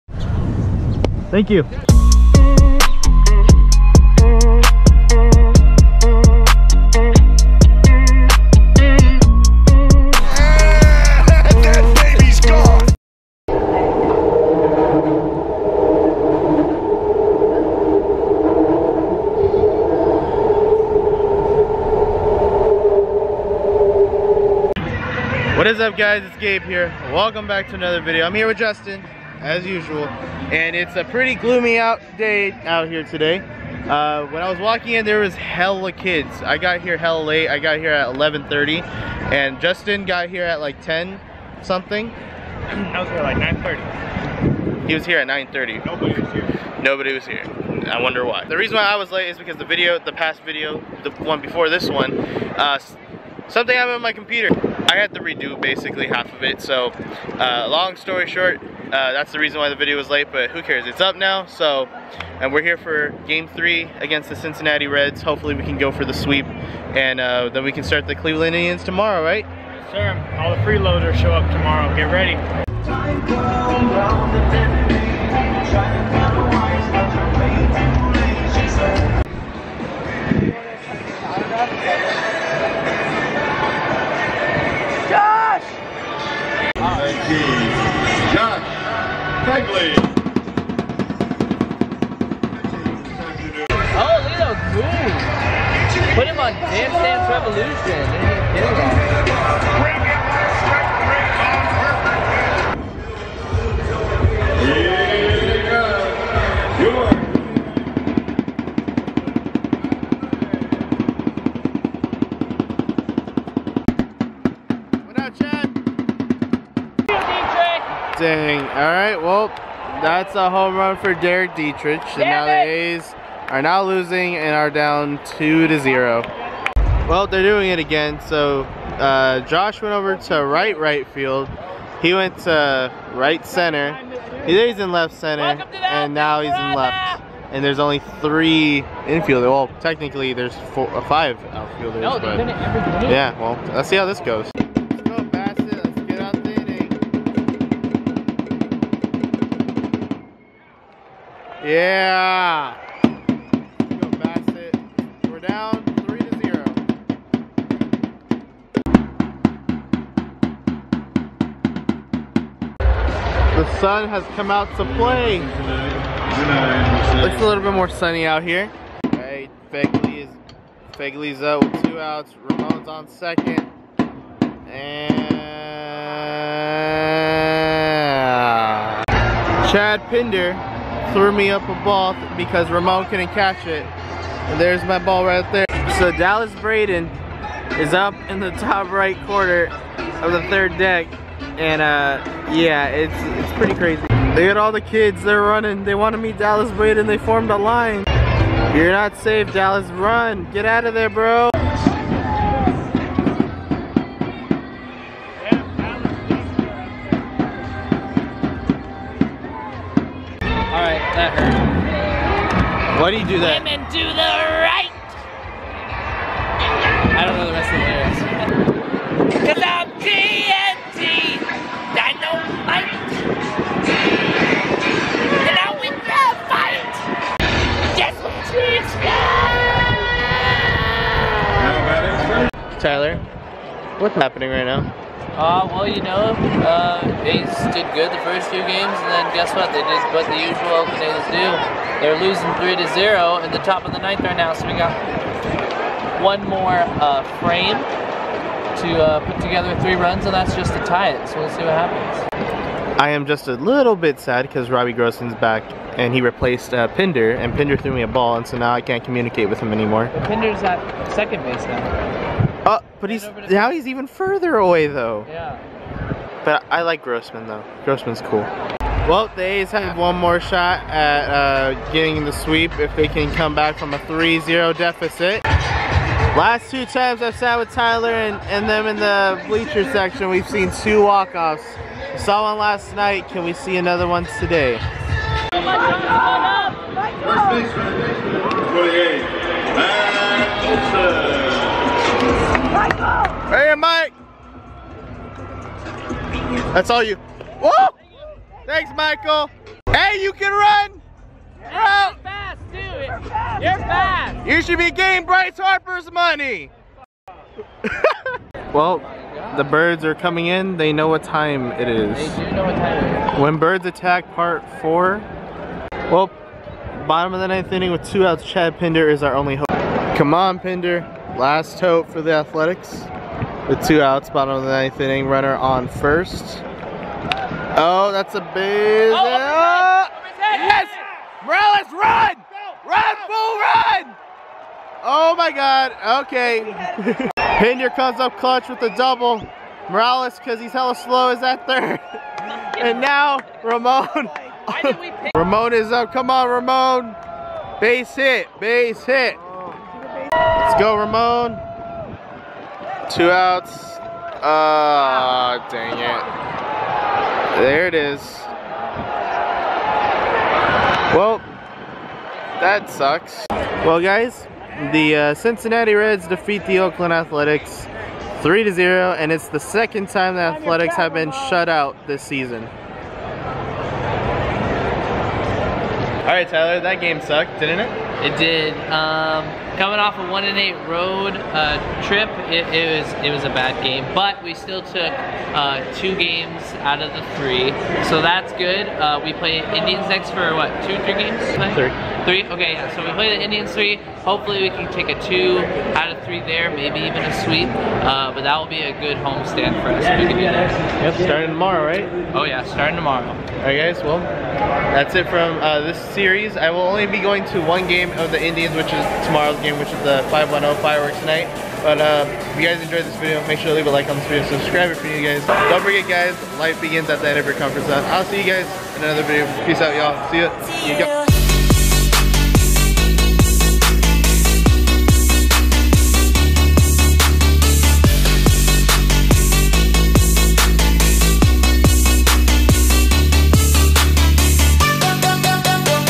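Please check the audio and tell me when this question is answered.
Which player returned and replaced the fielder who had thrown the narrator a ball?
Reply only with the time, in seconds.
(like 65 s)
254 s.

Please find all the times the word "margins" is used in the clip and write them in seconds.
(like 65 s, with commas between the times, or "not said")
not said.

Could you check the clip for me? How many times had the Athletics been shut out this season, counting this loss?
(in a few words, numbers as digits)
2.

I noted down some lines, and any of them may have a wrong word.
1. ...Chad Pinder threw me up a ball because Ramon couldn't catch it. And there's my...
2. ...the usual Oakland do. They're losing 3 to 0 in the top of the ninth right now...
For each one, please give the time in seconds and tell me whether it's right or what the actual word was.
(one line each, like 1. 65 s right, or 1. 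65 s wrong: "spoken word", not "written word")
1. 179 s right
2. 240 s right.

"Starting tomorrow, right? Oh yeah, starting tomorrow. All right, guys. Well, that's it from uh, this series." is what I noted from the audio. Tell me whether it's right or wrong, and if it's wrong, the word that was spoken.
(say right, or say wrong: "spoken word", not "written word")
right.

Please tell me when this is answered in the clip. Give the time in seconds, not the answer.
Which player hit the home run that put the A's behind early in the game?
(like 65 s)
121 s.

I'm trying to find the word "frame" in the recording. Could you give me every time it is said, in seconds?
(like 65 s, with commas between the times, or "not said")
247 s.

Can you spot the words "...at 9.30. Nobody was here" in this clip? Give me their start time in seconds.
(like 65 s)
45 s.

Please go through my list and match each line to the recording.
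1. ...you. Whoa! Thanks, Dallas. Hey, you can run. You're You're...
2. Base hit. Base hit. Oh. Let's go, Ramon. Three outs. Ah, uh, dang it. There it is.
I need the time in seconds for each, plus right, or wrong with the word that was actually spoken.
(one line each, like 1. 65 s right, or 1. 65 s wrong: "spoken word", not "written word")
1. 297 s wrong: "Michael", not "Dallas"
2. 347 s wrong: "Two", not "Three".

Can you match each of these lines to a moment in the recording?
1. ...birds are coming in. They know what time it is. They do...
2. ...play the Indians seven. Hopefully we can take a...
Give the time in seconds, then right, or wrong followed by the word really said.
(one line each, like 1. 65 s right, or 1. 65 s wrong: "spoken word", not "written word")
1. 309 s right
2. 393 s wrong: "three", not "seven".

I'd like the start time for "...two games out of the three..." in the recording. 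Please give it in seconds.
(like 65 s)
385 s.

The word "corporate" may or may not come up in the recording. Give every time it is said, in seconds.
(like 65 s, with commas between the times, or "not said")
not said.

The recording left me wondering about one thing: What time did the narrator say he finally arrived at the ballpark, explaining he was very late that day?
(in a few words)
11:30.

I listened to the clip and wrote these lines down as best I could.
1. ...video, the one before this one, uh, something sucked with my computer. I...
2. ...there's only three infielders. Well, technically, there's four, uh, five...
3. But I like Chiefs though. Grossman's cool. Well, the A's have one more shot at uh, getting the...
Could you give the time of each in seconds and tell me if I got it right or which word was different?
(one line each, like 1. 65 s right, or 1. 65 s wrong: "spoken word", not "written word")
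1. 50 s wrong: "happened", not "sucked"
2. 137 s right
3. 266 s wrong: "Grossman", not "Chiefs".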